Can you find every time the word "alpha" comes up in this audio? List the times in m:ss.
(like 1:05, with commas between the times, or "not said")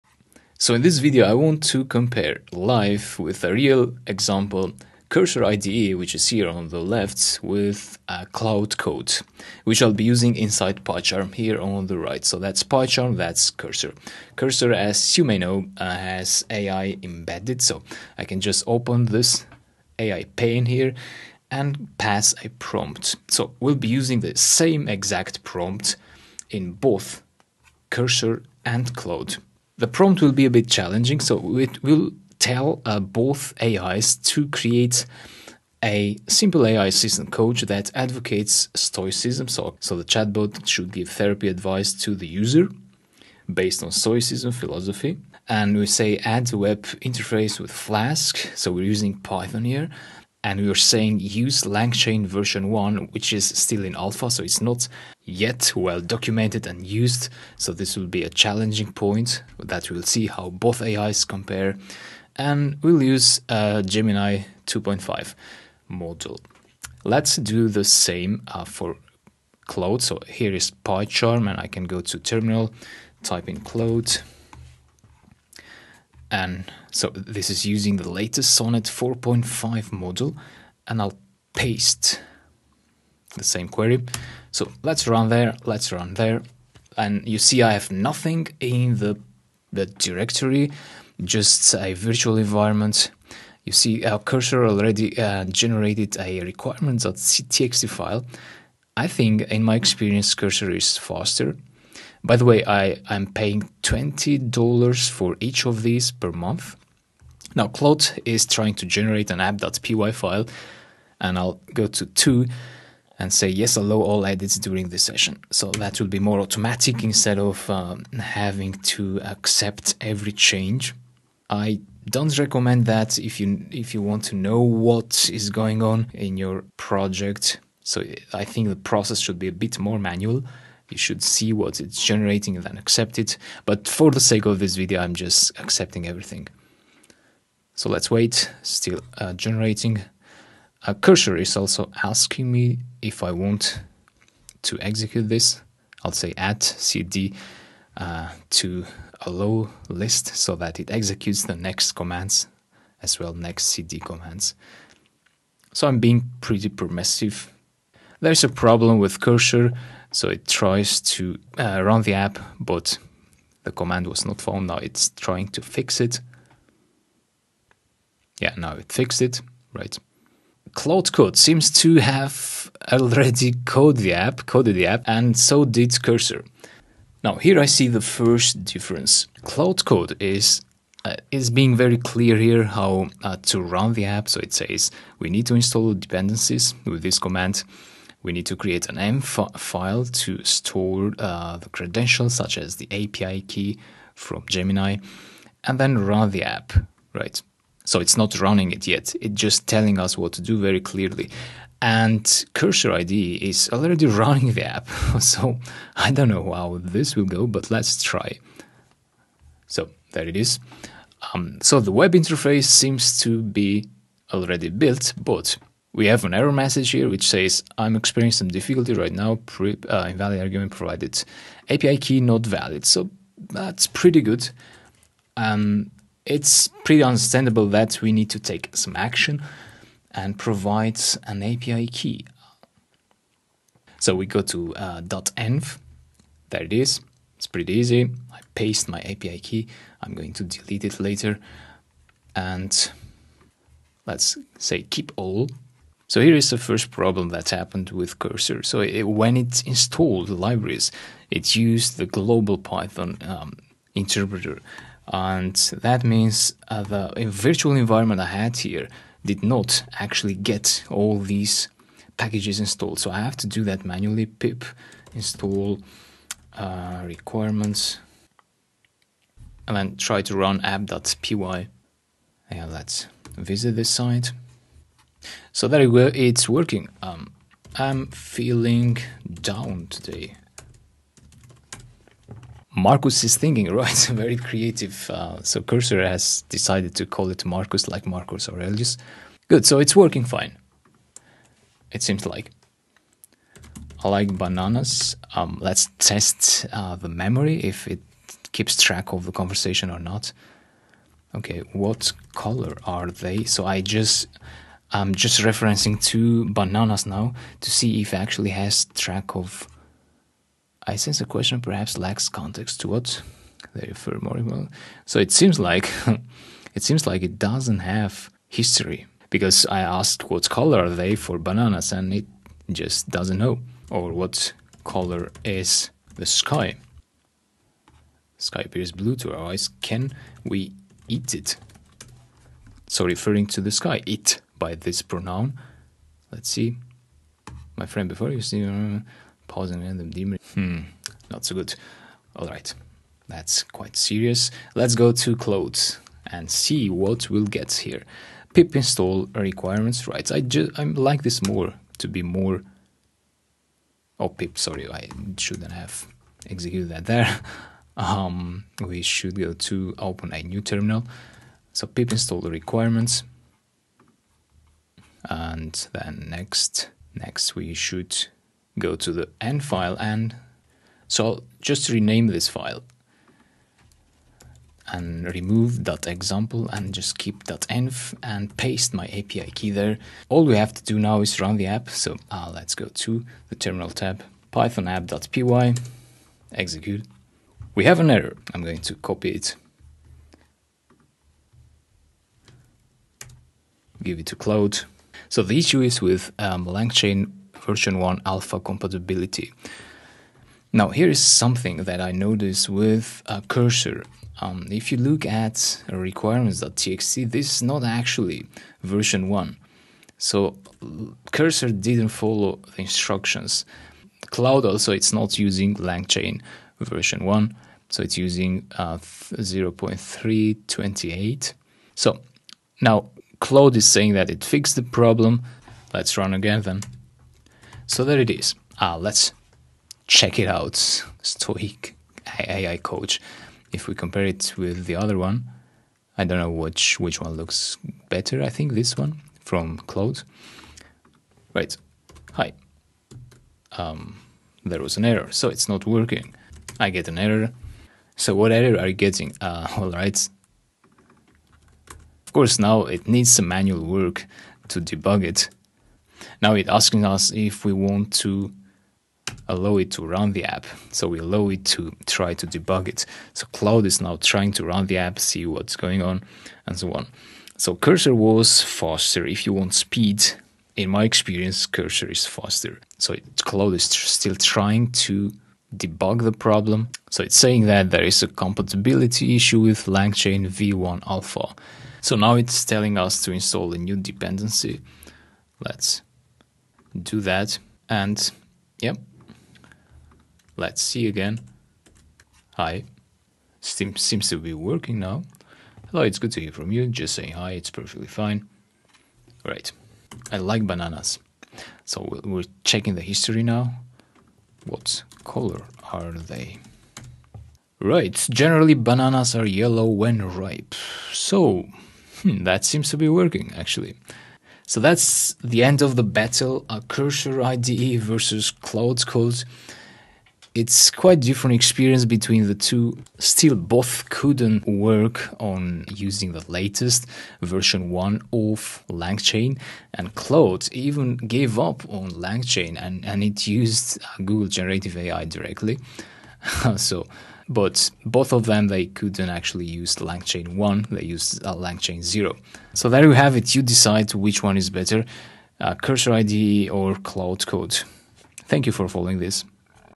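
0:53, 6:38, 8:01.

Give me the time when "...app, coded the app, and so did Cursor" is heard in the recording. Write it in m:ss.
2:54.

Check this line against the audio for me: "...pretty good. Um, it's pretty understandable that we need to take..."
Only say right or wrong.
right.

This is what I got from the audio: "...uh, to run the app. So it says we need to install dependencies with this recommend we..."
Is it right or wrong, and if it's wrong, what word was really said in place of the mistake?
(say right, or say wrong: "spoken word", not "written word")
wrong: "command", not "recommend".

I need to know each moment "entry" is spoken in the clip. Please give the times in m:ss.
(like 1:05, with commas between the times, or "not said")
not said.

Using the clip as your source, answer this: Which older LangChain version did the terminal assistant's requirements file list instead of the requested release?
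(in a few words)
0.328.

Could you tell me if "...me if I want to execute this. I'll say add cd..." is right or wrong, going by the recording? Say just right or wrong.
right.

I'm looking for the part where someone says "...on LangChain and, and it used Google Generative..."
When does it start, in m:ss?
8:51.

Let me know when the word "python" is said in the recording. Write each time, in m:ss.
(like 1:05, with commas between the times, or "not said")
0:49, 4:12, 6:24.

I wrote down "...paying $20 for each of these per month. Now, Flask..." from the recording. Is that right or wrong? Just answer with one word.
wrong.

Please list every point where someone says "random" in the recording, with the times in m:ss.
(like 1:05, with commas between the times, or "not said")
5:39.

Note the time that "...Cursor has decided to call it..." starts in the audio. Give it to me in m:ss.
4:45.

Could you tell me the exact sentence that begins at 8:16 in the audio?
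Just saying hi, it's perfectly fine.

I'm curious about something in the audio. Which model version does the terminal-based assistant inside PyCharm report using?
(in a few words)
Sonnet 4.5.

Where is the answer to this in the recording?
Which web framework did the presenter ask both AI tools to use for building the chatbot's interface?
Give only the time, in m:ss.
0:47.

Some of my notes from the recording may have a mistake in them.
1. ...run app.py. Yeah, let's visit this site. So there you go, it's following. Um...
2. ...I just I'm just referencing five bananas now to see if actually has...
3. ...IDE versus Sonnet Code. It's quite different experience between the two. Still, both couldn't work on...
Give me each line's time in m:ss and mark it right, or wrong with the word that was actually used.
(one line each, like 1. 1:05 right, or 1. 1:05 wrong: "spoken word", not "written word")
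1. 4:30 wrong: "working", not "following"
2. 5:03 wrong: "two", not "five"
3. 8:37 wrong: "Claude", not "Sonnet".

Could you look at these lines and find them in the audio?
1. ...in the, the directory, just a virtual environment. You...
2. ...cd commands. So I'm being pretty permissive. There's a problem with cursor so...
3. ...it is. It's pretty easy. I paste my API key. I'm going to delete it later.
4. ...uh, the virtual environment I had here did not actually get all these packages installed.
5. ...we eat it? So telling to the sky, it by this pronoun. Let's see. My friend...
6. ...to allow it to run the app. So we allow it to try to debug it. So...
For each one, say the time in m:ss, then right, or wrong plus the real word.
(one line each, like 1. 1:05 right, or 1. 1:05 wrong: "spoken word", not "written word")
1. 1:28 right
2. 2:33 right
3. 3:56 right
4. 4:16 right
5. 5:30 wrong: "referring", not "telling"
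6. 7:38 right.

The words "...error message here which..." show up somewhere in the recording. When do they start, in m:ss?
3:36.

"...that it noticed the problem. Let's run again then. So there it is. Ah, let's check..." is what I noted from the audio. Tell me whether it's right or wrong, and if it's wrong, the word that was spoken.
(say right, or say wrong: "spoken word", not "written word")
wrong: "fixed", not "noticed".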